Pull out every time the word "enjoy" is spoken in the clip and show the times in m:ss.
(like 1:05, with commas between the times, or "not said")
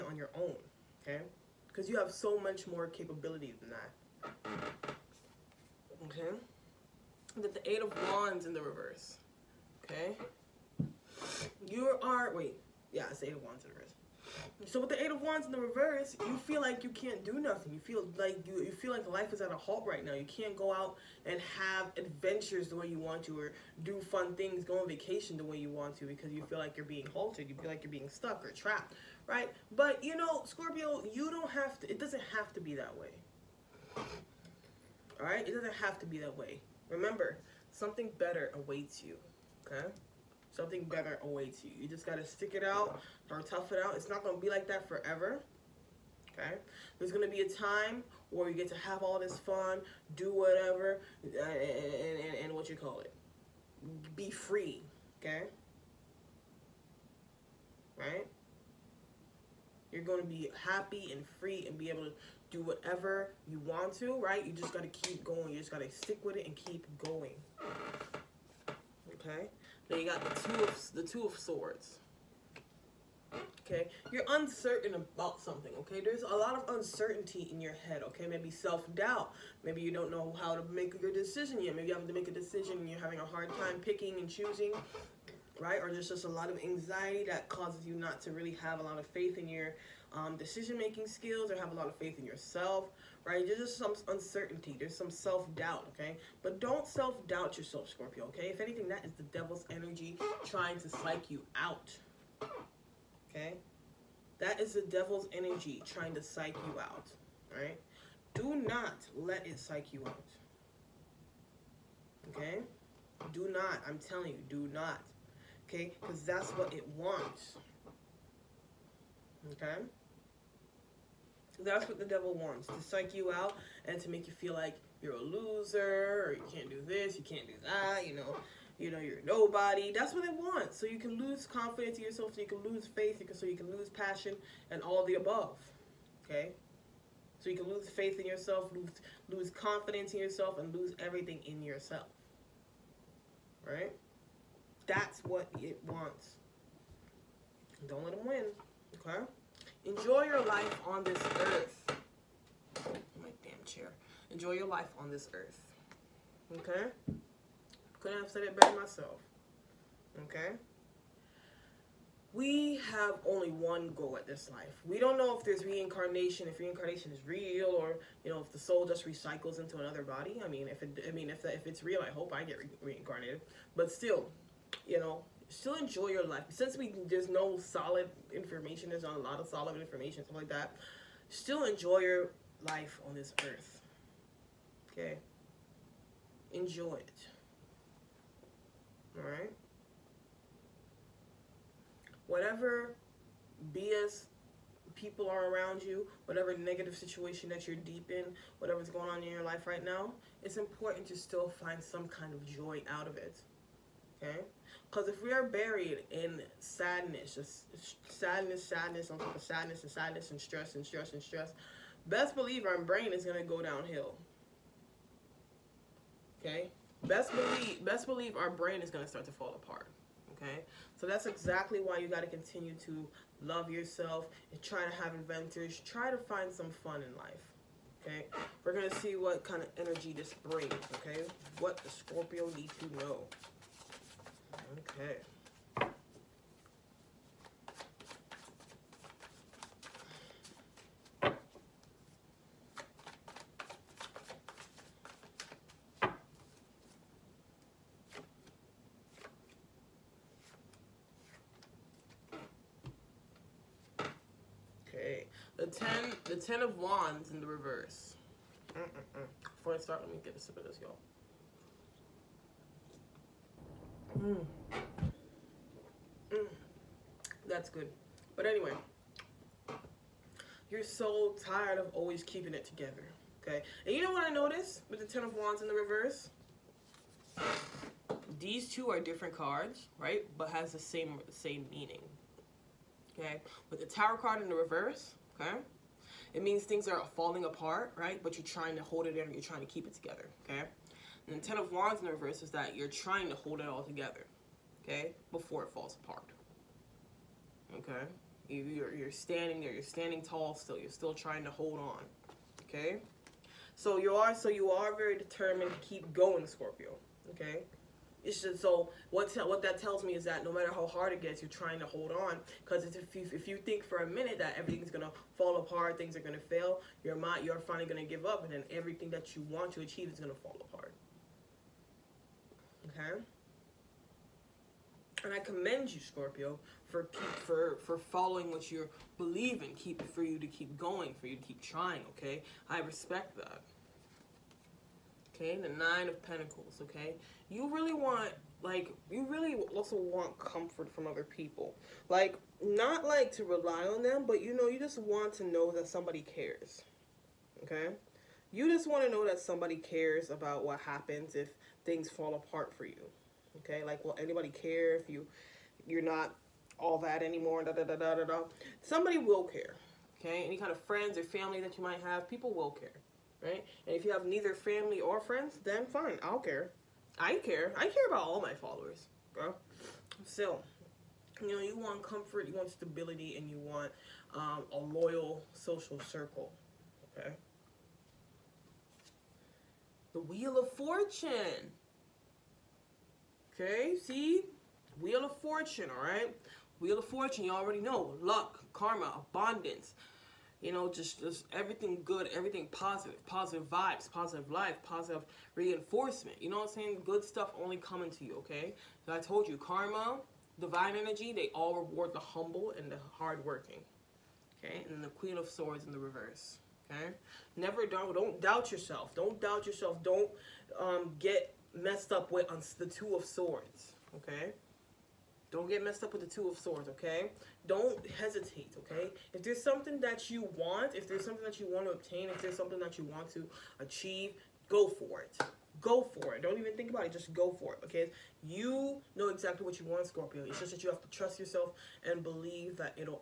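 2:29, 2:34, 2:55, 3:01, 3:06.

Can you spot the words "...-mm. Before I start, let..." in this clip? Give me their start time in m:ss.
4:19.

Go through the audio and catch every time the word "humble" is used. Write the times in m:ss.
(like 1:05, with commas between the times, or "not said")
6:42.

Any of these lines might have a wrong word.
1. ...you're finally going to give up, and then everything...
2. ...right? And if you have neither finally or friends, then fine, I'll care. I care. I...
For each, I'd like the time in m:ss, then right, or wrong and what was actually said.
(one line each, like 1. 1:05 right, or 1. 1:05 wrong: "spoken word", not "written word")
1. 5:17 right
2. 6:03 wrong: "family", not "finally".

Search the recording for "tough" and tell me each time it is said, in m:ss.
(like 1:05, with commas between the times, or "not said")
0:43.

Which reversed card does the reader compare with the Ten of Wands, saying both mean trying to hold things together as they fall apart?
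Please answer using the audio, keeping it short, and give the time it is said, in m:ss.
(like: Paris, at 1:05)
The Tower, at 4:43.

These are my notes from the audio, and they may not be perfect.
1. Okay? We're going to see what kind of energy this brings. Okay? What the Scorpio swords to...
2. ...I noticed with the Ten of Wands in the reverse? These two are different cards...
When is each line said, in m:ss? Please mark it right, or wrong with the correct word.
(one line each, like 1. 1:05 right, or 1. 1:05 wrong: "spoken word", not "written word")
1. 3:48 wrong: "needs", not "swords"
2. 4:34 right.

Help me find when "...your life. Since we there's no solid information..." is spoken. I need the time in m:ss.
2:56.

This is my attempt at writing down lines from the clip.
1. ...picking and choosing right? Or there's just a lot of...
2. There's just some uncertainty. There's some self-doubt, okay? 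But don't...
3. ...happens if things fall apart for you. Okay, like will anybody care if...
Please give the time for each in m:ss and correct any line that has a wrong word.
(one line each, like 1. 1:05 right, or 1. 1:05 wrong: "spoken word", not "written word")
1. 1:23 right
2. 1:33 right
3. 5:50 right.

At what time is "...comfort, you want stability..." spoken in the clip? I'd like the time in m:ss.
6:12.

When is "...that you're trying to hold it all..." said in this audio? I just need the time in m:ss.
4:52.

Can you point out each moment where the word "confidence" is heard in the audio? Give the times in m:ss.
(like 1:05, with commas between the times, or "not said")
2:11, 2:19.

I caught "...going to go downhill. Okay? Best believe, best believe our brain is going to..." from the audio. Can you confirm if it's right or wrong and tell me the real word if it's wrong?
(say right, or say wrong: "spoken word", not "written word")
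right.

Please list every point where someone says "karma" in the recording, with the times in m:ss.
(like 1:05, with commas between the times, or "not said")
6:28, 6:39.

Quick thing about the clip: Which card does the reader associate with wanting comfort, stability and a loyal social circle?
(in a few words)
Nine of Pentacles.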